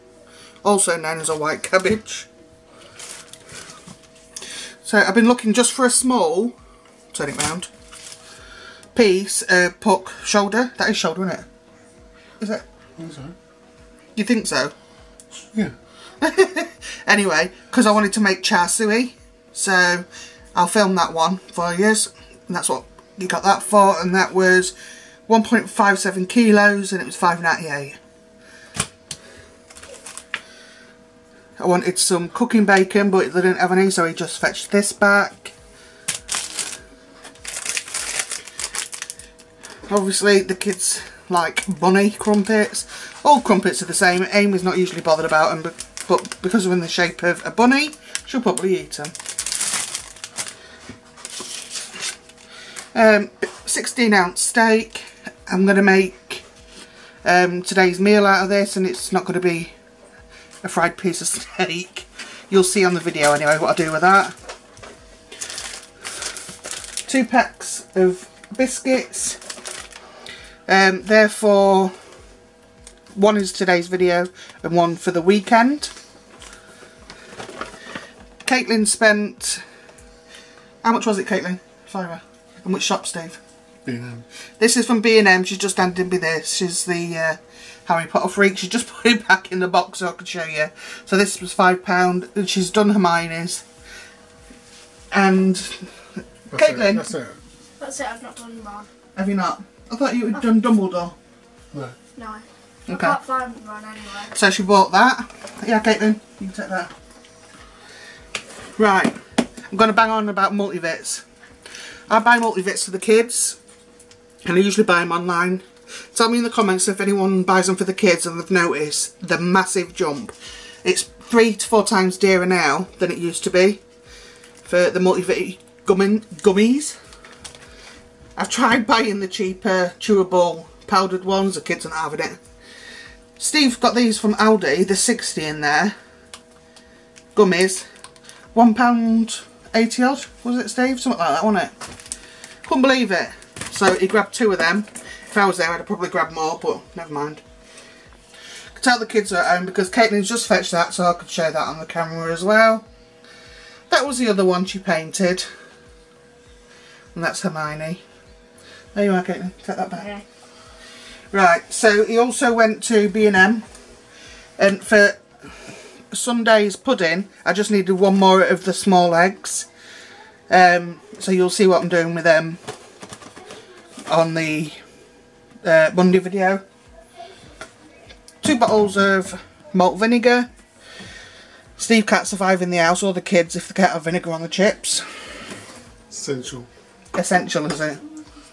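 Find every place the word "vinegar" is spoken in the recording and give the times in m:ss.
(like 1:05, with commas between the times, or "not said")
2:59, 3:04.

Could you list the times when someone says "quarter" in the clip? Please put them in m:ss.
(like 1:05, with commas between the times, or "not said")
not said.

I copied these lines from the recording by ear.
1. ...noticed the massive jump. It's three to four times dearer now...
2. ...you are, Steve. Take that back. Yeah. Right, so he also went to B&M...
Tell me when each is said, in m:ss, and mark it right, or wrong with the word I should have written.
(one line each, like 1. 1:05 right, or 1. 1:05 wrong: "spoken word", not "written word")
1. 1:58 right
2. 2:39 wrong: "Caitlin", not "Steve".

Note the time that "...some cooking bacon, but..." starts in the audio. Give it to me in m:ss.
0:31.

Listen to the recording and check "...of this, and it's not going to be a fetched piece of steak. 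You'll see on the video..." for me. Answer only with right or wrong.
wrong.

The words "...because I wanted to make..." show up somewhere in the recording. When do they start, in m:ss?
0:17.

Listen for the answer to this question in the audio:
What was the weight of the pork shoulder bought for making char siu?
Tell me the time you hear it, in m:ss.
0:25.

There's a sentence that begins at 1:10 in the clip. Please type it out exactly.
Um, therefore, one is today's video and one for the weekend.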